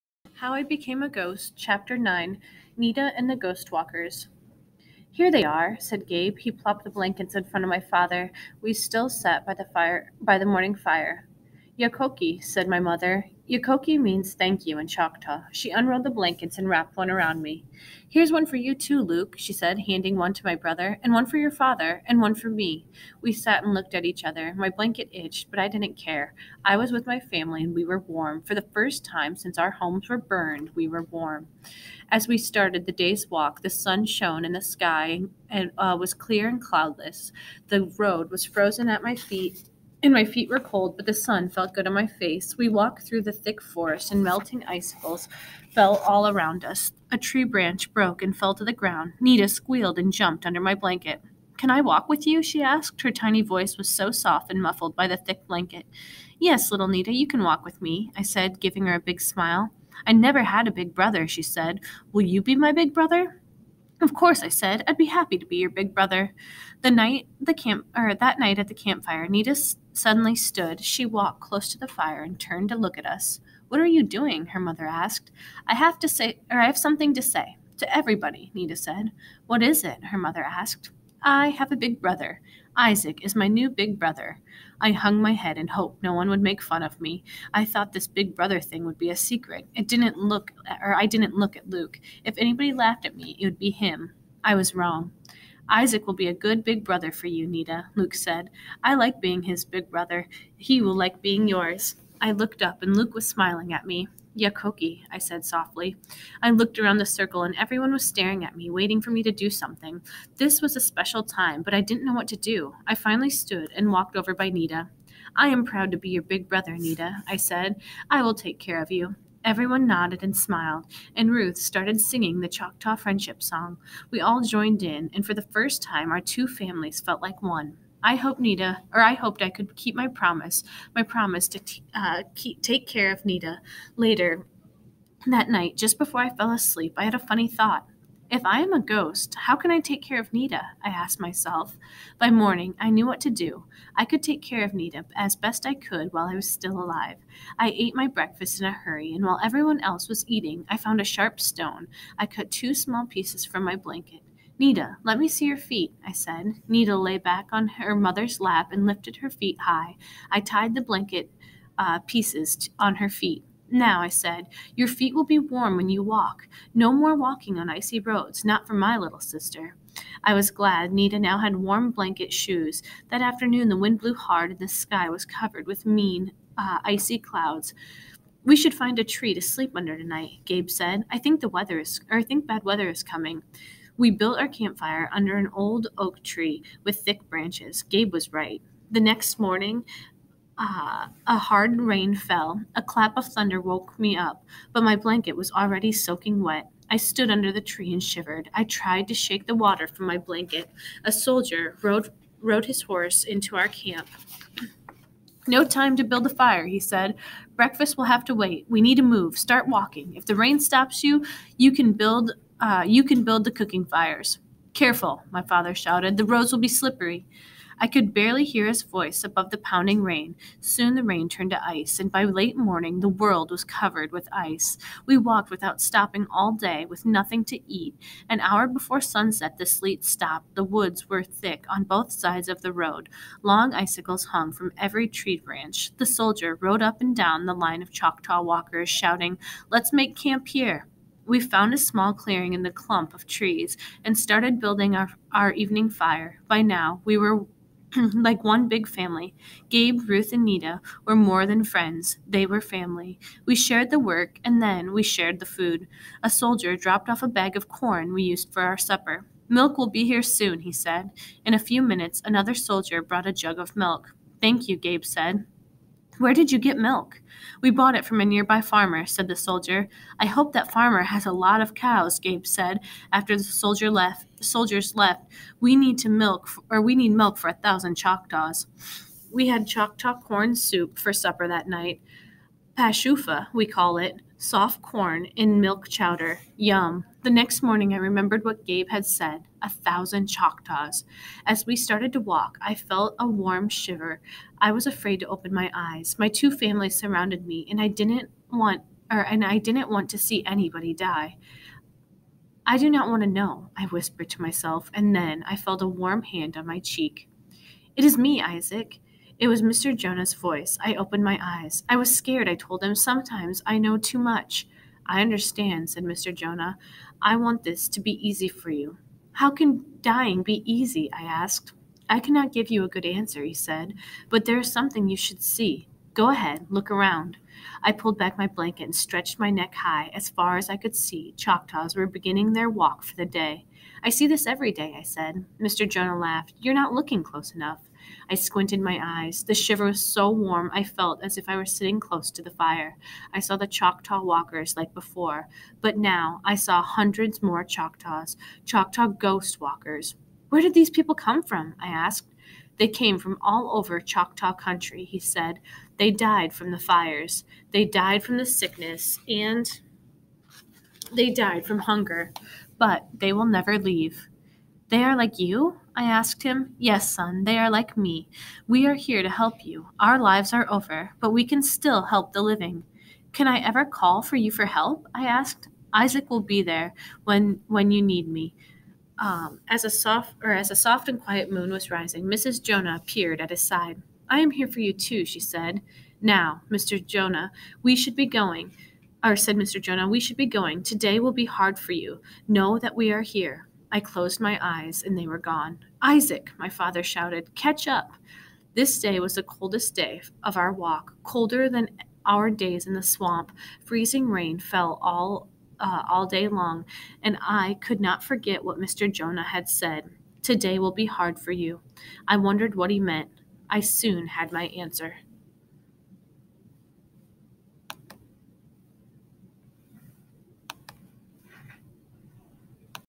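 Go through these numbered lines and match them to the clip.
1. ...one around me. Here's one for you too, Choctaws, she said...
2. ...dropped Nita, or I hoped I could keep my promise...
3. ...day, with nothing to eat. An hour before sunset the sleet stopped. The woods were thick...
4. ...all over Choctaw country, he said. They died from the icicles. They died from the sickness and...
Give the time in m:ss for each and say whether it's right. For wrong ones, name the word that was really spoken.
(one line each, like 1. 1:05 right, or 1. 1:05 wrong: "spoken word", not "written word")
1. 0:16 wrong: "Luke", not "Choctaws"
2. 2:08 wrong: "hoped", not "dropped"
3. 3:46 right
4. 5:53 wrong: "fires", not "icicles".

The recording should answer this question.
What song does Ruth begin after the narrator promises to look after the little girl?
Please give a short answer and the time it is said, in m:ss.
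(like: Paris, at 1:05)
Choctaw Friendship Song, at 2:02.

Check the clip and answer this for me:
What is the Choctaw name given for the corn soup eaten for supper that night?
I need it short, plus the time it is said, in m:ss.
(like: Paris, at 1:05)
Pashofa, at 4:42.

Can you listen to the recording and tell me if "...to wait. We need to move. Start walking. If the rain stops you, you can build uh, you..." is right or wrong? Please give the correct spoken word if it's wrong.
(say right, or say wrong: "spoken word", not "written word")
right.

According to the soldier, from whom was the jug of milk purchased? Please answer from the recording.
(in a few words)
A nearby farmer.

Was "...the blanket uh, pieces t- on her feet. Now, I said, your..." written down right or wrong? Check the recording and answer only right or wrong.
right.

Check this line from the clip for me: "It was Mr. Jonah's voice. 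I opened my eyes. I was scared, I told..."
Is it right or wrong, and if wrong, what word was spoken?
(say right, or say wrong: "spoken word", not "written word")
right.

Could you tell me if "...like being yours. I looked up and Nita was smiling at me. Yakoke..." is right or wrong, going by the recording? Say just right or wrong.
wrong.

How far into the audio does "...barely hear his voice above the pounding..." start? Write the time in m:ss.
3:38.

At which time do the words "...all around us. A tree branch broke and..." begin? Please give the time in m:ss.
0:45.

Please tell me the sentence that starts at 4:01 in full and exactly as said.
We found a small clearing in the clump of trees and started building our, our evening fire.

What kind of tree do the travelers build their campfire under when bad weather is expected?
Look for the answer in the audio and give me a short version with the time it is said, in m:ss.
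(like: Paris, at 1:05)
Oak tree, at 3:05.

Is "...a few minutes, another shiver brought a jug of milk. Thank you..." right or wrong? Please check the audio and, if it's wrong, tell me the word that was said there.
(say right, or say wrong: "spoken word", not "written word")
wrong: "soldier", not "shiver".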